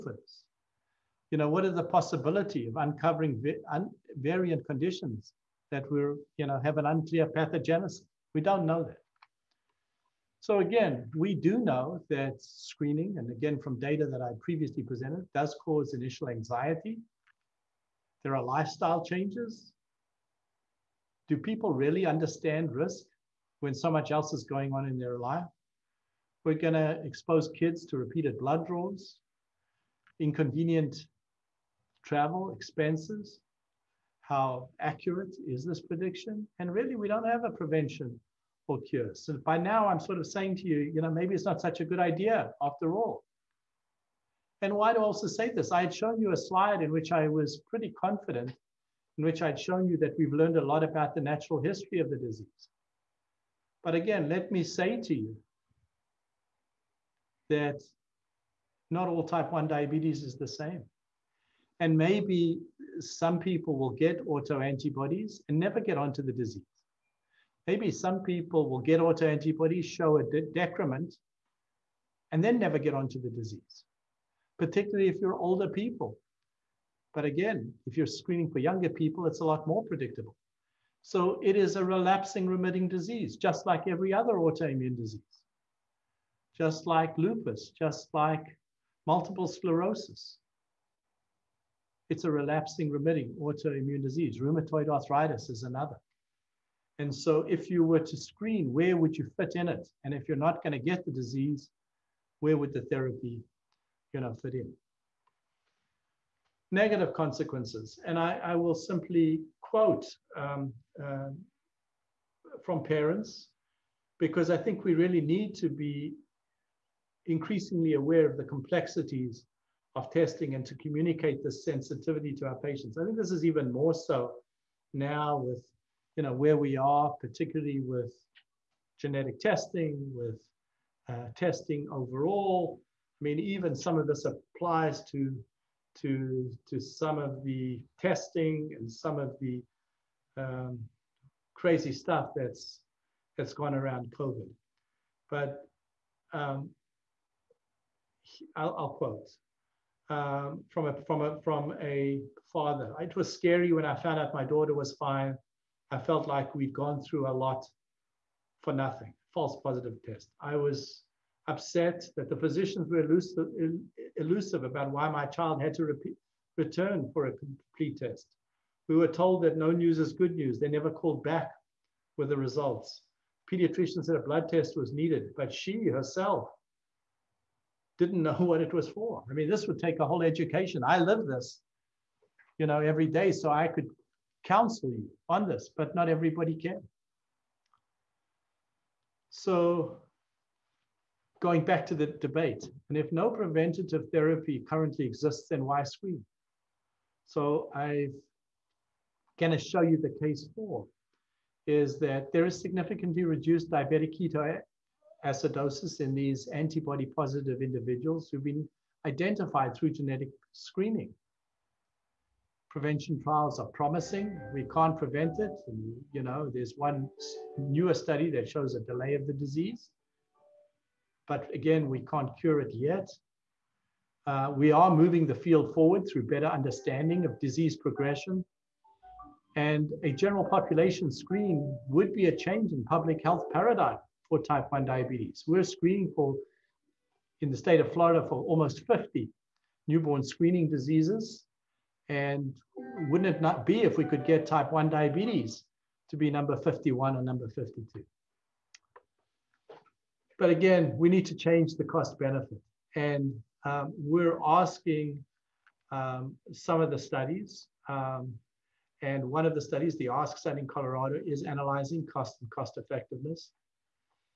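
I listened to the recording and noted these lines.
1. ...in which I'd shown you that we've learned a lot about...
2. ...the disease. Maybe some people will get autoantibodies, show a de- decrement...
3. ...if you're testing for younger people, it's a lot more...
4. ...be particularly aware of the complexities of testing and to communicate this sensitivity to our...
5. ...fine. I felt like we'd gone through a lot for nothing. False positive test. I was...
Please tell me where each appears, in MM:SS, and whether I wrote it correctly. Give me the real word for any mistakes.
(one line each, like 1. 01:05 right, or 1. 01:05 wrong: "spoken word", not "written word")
1. 00:49 right
2. 01:06 right
3. 01:17 wrong: "screening", not "testing"
4. 01:55 wrong: "increasingly", not "particularly"
5. 02:34 right.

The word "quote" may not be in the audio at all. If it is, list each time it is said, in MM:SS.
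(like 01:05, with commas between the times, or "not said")
01:49, 02:28.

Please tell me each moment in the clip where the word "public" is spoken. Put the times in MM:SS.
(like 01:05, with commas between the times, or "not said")
03:52.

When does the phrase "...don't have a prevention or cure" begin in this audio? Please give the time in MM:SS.
00:37.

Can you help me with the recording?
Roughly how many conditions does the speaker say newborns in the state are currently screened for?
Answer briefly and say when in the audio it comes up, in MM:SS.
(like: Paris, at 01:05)
50, at 03:58.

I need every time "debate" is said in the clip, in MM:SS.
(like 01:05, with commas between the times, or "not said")
03:12.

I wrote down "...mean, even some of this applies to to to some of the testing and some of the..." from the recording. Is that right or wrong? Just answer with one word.
right.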